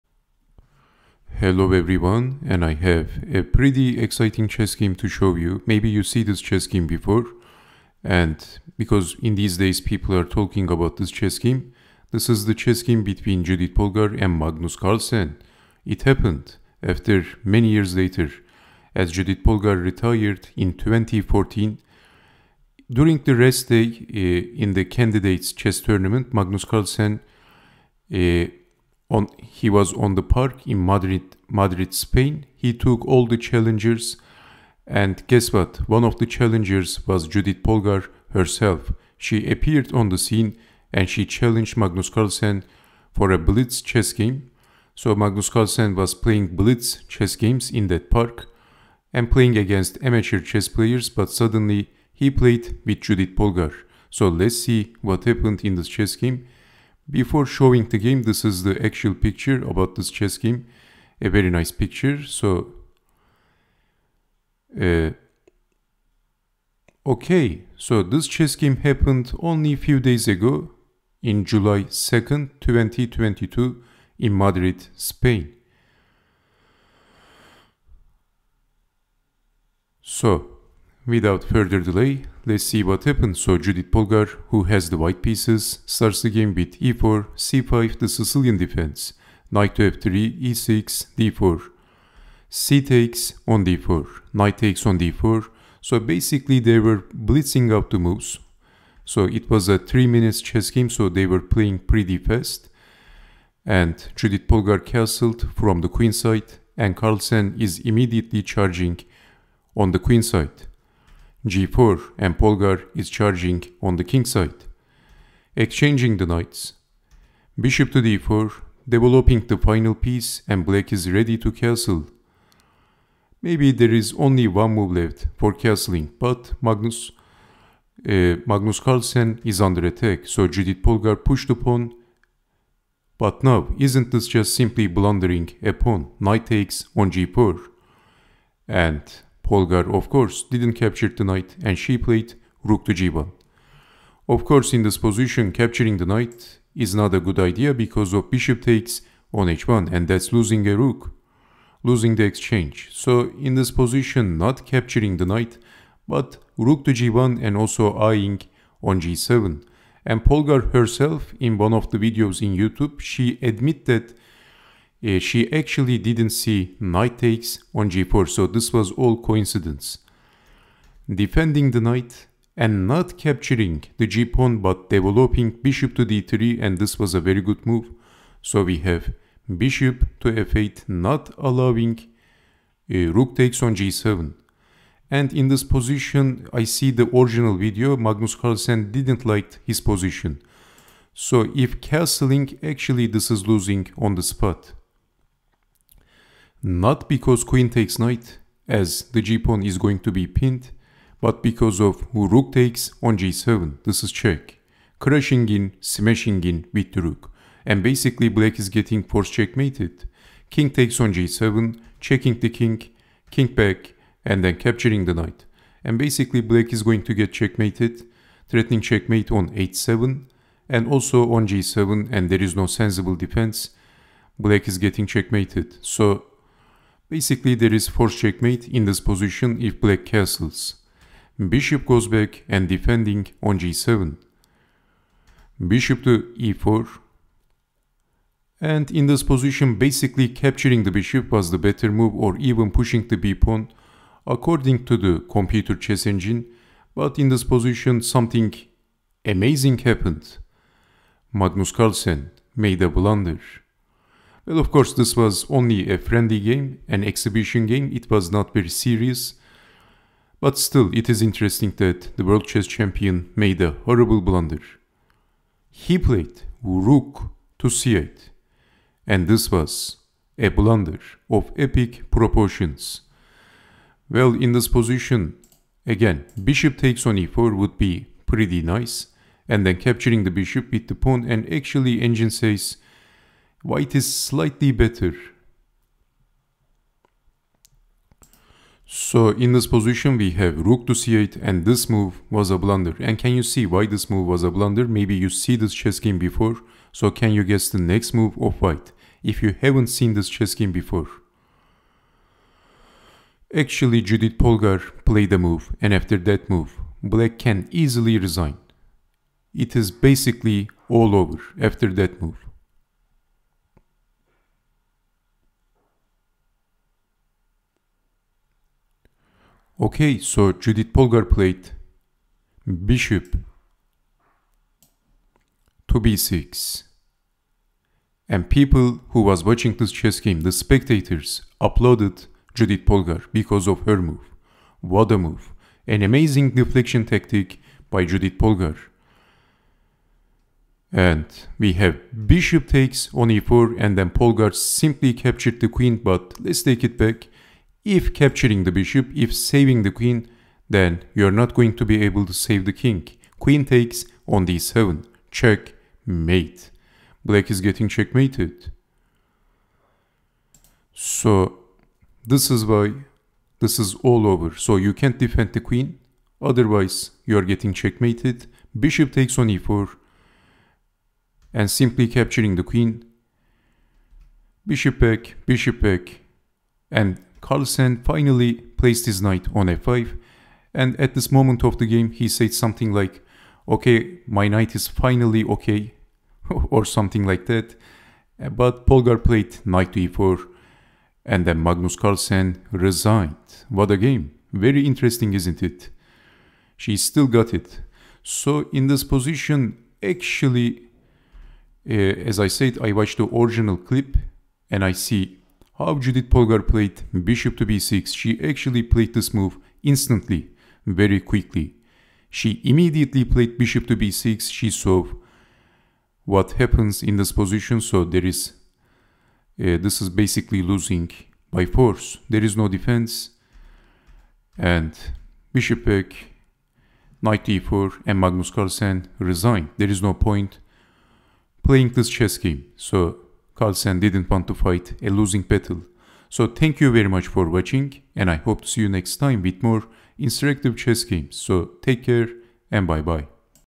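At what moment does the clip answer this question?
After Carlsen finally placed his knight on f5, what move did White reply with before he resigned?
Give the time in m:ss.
6:29.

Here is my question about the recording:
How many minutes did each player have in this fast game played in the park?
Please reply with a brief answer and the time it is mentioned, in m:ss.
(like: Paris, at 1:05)
3, at 1:39.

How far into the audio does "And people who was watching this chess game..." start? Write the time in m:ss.
5:28.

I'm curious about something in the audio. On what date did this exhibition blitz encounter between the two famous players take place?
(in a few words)
July 2nd, 2022.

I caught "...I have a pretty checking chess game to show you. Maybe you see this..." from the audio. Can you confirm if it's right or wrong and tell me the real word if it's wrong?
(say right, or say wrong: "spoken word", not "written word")
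wrong: "exciting", not "checking".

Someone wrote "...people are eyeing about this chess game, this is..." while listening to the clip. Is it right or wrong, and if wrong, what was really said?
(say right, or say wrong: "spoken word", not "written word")
wrong: "talking", not "eyeing".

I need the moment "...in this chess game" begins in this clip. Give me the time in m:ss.
0:55.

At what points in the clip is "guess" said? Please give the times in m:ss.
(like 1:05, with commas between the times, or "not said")
0:35, 4:57.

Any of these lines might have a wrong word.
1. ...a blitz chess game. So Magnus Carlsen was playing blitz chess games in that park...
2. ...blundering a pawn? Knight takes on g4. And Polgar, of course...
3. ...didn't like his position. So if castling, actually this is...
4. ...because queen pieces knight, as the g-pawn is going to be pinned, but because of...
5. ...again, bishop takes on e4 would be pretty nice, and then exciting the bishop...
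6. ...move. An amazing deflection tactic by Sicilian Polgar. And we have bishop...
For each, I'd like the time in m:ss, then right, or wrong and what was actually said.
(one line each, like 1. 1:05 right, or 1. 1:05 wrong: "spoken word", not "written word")
1. 0:43 right
2. 2:14 right
3. 3:08 right
4. 3:17 wrong: "takes", not "pieces"
5. 4:35 wrong: "capturing", not "exciting"
6. 5:35 wrong: "Judit", not "Sicilian".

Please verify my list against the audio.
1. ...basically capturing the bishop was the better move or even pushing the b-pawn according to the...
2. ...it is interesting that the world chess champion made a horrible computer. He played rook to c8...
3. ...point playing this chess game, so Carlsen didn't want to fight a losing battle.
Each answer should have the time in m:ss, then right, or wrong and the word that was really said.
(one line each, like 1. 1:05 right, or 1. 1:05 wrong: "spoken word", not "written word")
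1. 3:59 right
2. 4:20 wrong: "blunder", not "computer"
3. 7:10 right.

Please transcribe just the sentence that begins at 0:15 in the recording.
It happened after many years later, as Judit Polgar retired in 2014.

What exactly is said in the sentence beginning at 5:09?
It is basically all over after that move.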